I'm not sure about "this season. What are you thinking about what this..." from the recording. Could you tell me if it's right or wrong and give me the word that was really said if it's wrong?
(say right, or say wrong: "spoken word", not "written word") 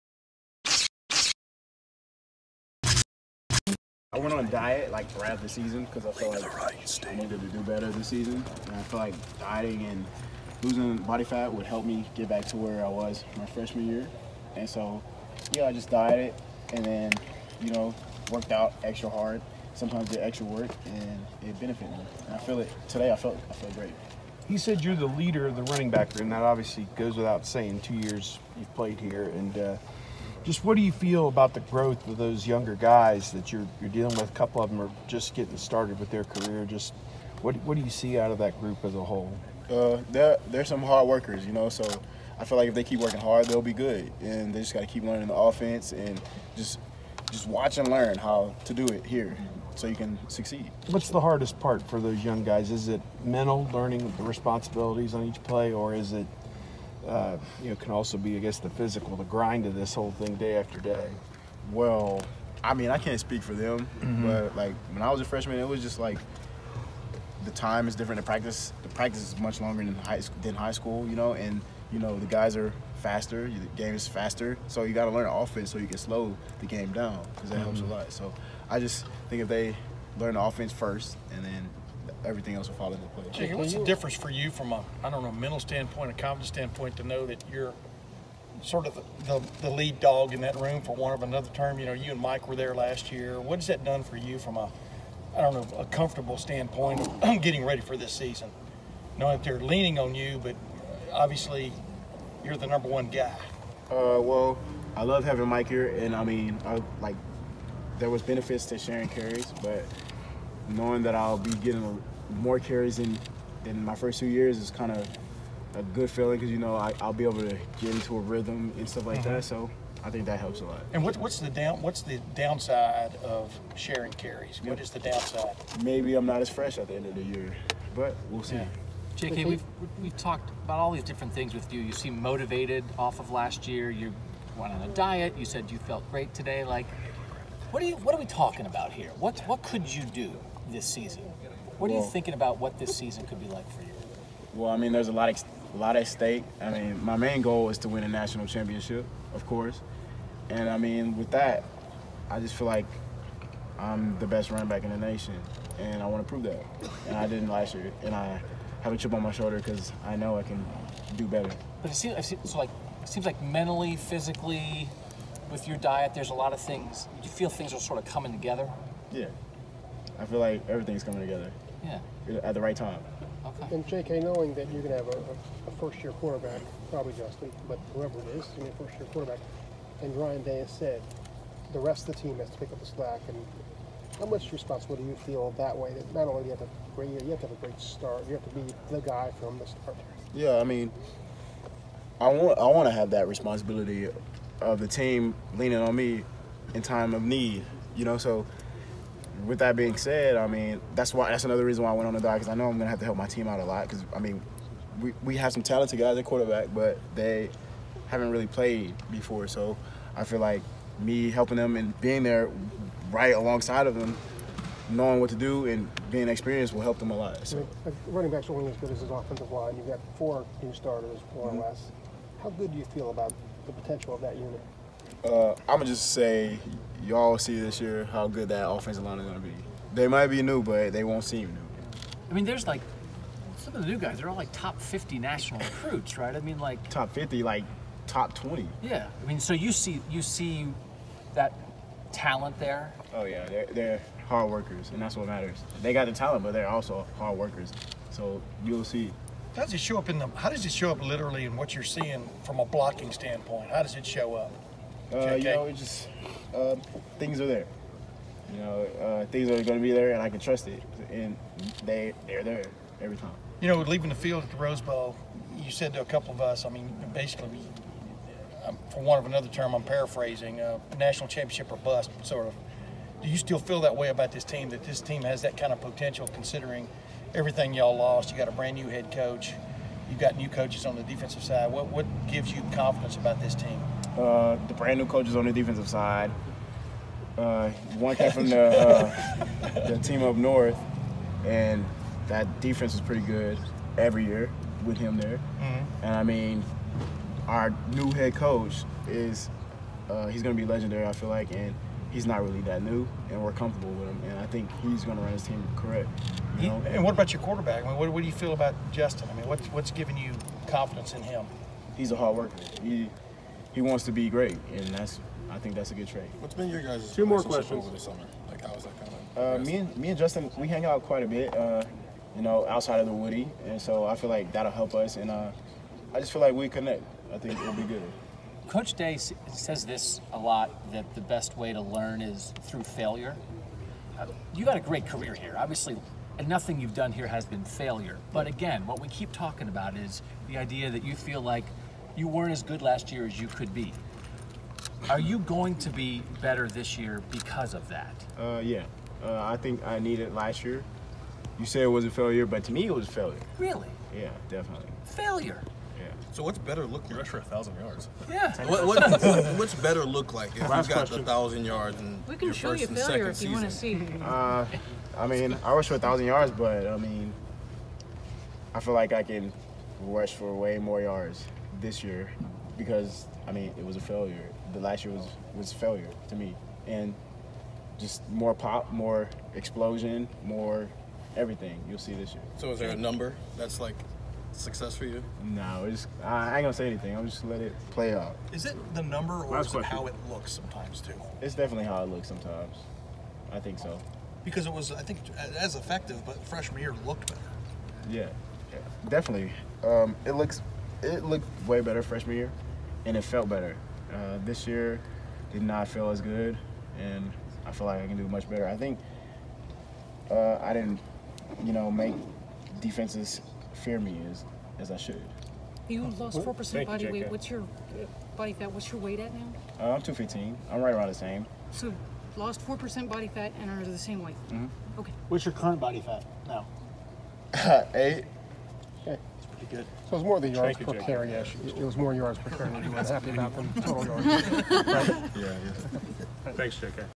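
right.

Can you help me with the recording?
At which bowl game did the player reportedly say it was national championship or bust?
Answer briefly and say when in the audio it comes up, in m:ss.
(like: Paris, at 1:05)
Rose Bowl, at 4:24.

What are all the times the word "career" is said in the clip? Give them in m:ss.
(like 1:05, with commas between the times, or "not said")
0:36, 5:35.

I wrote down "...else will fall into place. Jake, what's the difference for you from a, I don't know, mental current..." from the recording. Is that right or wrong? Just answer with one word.
wrong.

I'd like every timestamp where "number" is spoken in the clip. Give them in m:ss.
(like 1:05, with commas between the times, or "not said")
1:42, 6:22, 6:29.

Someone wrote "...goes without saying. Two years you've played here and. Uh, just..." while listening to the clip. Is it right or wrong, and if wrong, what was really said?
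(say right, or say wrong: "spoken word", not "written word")
right.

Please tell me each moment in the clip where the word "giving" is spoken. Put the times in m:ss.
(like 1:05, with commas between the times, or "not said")
5:09.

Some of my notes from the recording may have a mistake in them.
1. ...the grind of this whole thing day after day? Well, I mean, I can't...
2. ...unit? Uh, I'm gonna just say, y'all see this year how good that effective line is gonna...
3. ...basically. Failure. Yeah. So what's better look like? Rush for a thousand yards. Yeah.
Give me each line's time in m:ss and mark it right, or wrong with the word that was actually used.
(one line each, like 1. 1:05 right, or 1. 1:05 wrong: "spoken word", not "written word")
1. 0:59 right
2. 3:44 wrong: "offensive", not "effective"
3. 5:54 wrong: "definitely", not "basically".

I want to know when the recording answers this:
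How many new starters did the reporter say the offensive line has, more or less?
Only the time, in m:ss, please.
3:40.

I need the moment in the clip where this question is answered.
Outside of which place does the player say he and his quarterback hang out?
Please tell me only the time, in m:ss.
5:23.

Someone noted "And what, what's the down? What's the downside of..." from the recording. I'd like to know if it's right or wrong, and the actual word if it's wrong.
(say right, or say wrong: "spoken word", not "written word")
right.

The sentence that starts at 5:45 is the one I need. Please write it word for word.
Are you going to be better this year because of that?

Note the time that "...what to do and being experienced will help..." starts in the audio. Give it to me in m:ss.
3:35.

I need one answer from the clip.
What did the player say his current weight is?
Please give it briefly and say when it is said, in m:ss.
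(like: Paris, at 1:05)
215, at 7:00.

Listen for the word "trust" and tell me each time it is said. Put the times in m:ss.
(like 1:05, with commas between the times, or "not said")
4:20.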